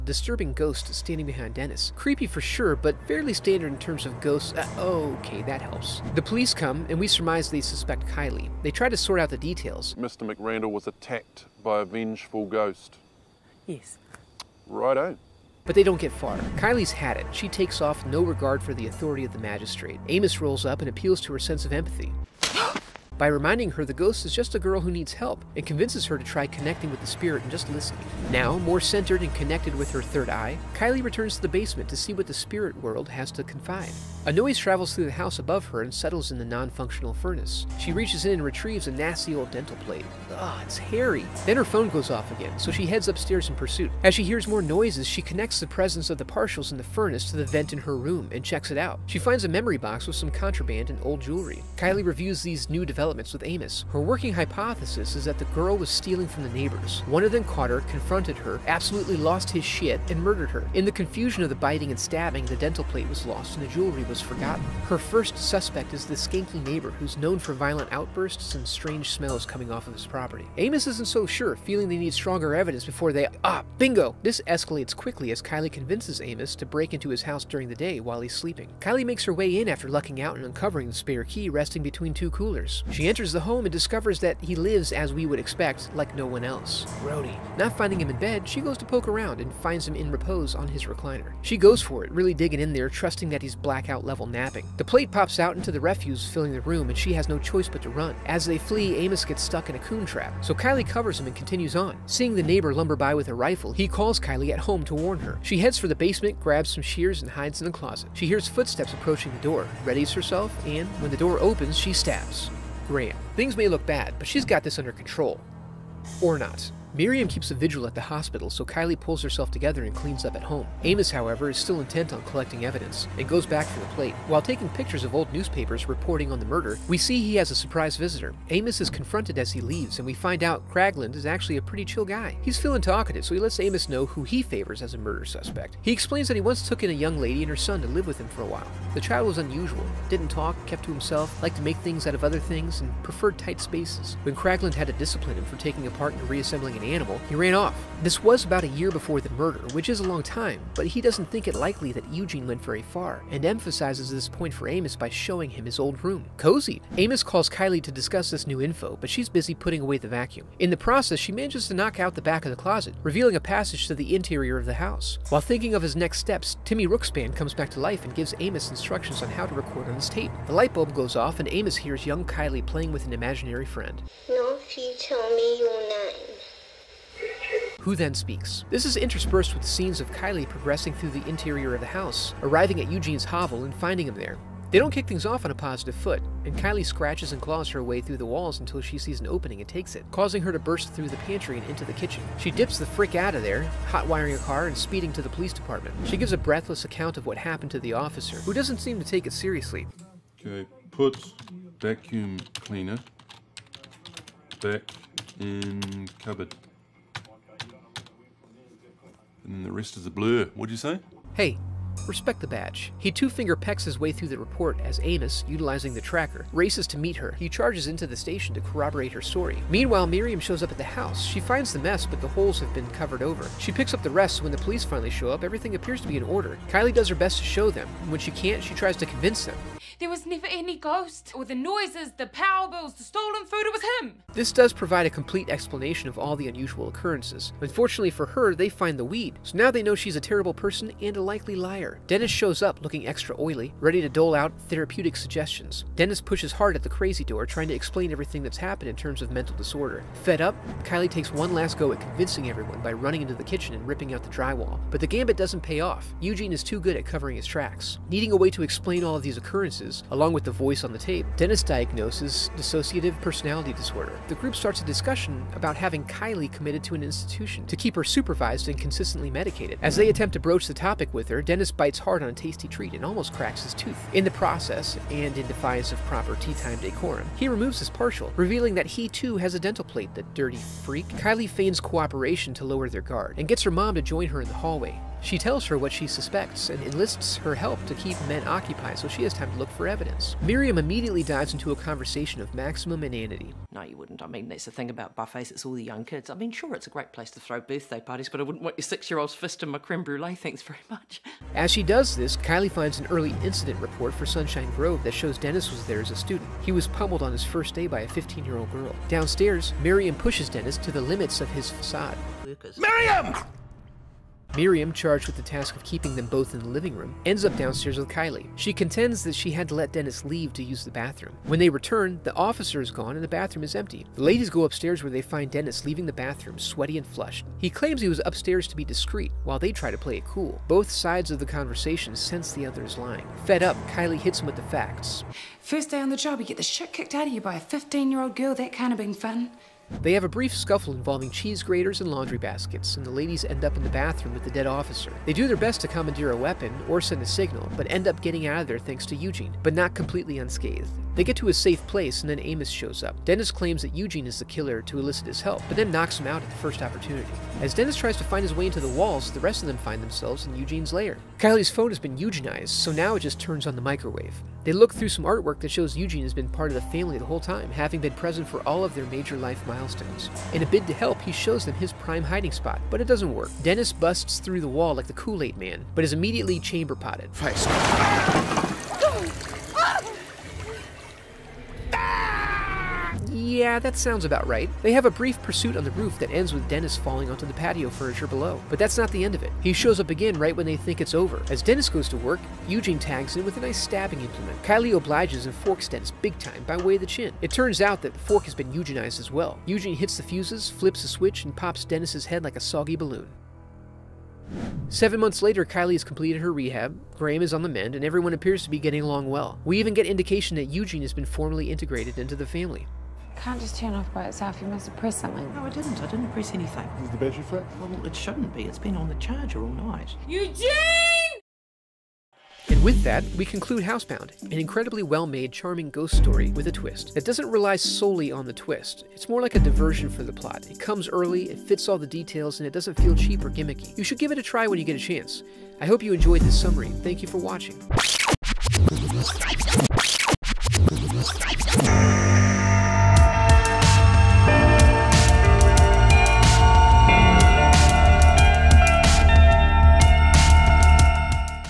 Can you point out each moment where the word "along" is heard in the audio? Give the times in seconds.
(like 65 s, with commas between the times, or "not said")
260 s, 409 s.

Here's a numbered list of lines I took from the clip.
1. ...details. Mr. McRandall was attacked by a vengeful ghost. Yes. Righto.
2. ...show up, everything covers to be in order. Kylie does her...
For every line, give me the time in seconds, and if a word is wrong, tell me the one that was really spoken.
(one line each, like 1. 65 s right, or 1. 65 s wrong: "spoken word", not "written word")
1. 9 s right
2. 225 s wrong: "appears", not "covers".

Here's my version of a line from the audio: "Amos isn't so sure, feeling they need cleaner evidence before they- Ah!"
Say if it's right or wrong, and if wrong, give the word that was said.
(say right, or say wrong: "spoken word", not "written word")
wrong: "stronger", not "cleaner".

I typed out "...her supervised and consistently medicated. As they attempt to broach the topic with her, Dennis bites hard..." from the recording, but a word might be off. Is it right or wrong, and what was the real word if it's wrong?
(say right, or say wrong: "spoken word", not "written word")
right.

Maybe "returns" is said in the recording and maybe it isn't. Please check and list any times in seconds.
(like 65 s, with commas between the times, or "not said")
31 s, 321 s.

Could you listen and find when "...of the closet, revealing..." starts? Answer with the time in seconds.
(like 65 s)
162 s.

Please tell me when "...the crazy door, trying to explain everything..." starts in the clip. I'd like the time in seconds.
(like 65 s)
246 s.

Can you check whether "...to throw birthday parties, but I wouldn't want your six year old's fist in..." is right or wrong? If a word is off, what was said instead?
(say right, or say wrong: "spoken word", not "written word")
right.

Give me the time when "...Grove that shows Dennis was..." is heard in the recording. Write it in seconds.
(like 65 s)
304 s.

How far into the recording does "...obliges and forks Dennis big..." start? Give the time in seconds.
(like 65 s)
394 s.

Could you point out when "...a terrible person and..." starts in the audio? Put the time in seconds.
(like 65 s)
240 s.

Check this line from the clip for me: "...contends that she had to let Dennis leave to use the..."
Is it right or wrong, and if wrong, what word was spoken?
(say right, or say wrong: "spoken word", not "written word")
right.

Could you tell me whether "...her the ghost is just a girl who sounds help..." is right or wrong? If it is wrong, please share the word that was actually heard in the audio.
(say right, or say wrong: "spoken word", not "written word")
wrong: "needs", not "sounds".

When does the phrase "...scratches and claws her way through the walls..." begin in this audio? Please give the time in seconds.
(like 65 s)
186 s.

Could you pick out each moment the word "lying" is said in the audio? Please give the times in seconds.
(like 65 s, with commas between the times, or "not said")
332 s.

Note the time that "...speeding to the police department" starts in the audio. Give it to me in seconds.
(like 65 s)
194 s.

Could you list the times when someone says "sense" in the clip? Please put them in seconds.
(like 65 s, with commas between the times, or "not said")
21 s, 332 s.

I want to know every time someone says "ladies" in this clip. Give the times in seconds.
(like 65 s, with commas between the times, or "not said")
324 s, 343 s.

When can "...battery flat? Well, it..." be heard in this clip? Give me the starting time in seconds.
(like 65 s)
417 s.